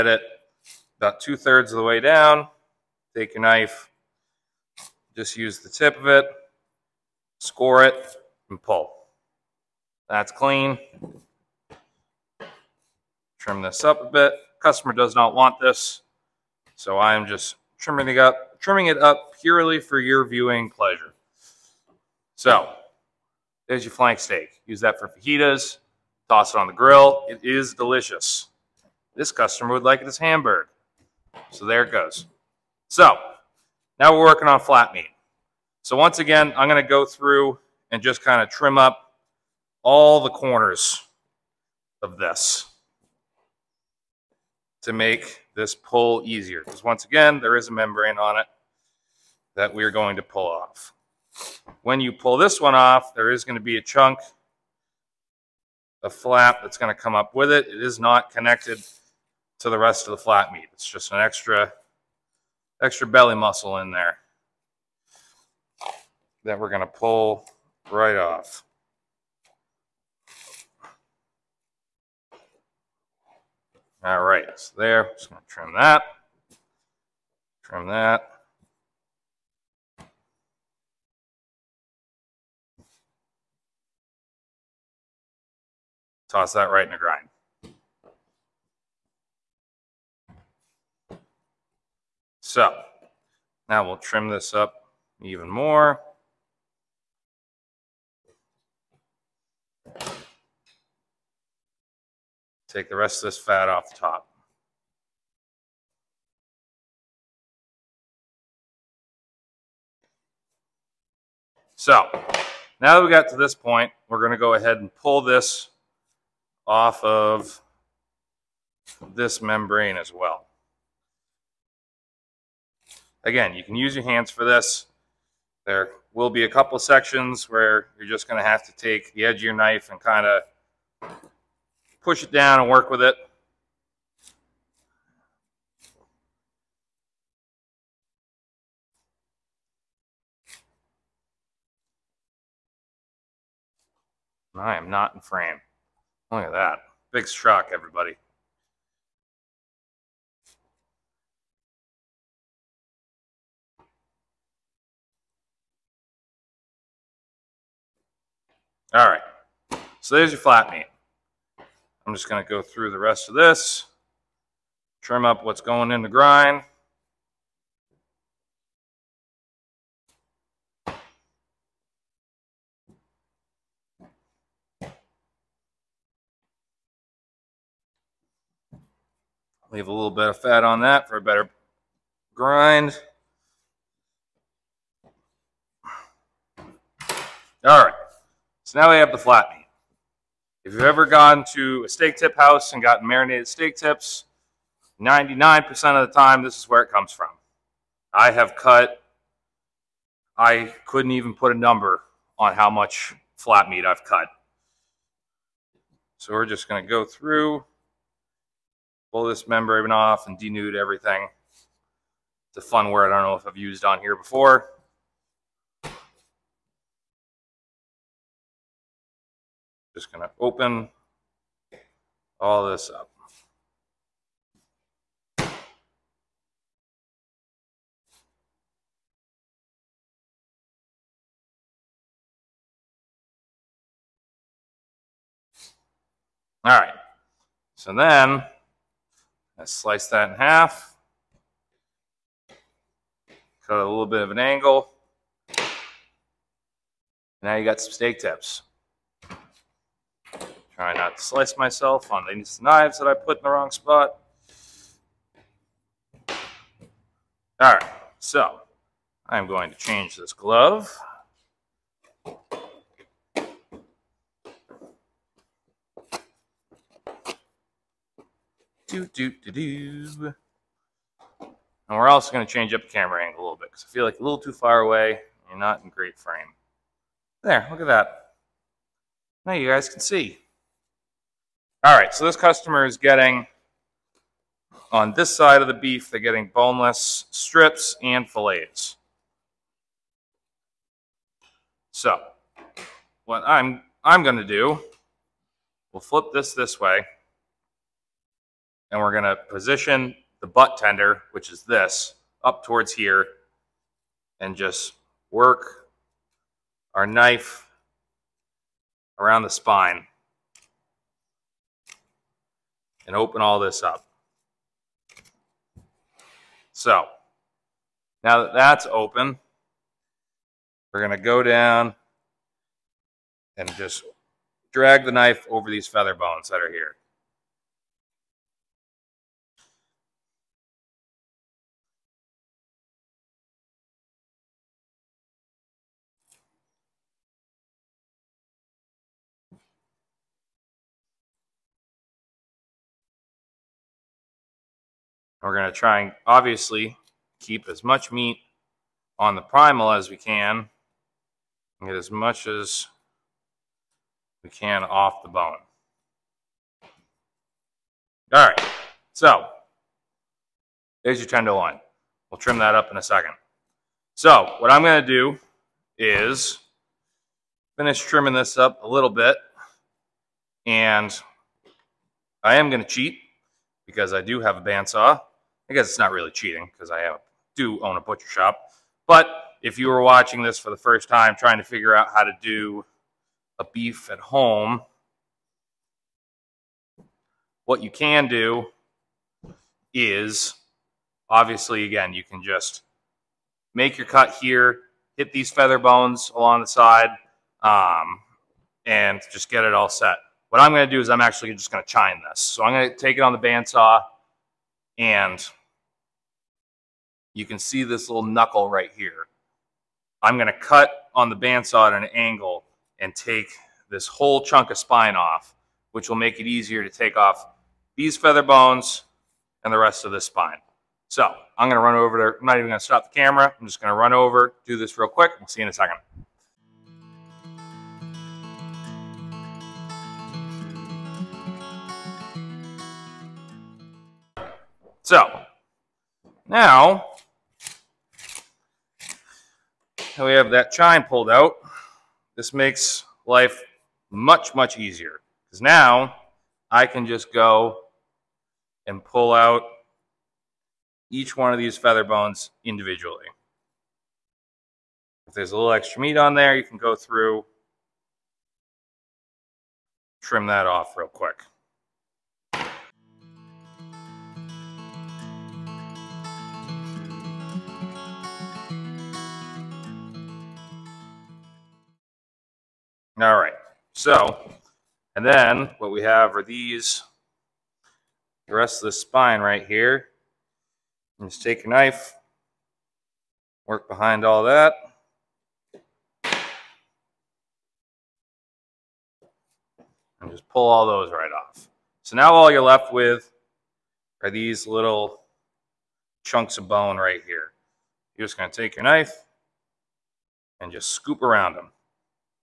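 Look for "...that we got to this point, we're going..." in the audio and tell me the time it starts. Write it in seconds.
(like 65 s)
112 s.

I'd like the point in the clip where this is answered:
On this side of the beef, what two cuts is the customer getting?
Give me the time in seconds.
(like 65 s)
286 s.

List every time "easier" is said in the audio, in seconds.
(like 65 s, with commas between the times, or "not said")
46 s, 416 s, 444 s.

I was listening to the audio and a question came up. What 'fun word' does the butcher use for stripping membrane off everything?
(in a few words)
Denude.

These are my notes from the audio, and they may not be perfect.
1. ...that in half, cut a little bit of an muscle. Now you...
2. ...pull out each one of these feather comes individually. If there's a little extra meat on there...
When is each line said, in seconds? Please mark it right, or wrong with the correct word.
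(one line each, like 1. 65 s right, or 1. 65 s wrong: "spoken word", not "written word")
1. 240 s wrong: "angle", not "muscle"
2. 449 s wrong: "bones", not "comes".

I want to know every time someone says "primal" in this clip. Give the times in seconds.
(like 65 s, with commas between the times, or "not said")
349 s.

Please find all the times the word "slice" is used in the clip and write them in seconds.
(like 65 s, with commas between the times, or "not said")
239 s, 251 s.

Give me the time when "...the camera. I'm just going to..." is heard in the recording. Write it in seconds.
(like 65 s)
423 s.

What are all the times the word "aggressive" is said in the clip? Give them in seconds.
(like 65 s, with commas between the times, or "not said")
not said.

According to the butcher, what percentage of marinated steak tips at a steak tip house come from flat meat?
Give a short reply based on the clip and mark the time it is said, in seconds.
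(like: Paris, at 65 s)
99%, at 195 s.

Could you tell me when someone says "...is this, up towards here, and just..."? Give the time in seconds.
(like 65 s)
301 s.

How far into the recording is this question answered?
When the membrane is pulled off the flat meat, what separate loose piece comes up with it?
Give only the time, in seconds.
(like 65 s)
63 s.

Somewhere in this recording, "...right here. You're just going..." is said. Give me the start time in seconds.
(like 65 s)
496 s.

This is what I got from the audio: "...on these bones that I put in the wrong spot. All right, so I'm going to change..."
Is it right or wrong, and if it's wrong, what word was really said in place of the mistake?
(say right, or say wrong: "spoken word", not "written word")
wrong: "knives", not "bones".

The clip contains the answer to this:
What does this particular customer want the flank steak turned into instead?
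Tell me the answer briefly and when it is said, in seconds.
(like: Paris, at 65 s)
Hamburger, at 30 s.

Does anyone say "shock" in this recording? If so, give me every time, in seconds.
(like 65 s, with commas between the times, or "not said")
147 s.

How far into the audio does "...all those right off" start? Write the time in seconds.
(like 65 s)
490 s.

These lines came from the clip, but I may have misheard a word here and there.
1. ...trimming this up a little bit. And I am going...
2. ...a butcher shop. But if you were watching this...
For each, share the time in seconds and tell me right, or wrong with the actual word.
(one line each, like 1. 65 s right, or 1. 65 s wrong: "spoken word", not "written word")
1. 367 s right
2. 377 s right.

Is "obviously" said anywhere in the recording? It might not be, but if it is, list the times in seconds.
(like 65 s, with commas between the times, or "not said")
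346 s, 391 s.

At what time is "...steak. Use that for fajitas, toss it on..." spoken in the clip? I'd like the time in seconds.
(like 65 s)
24 s.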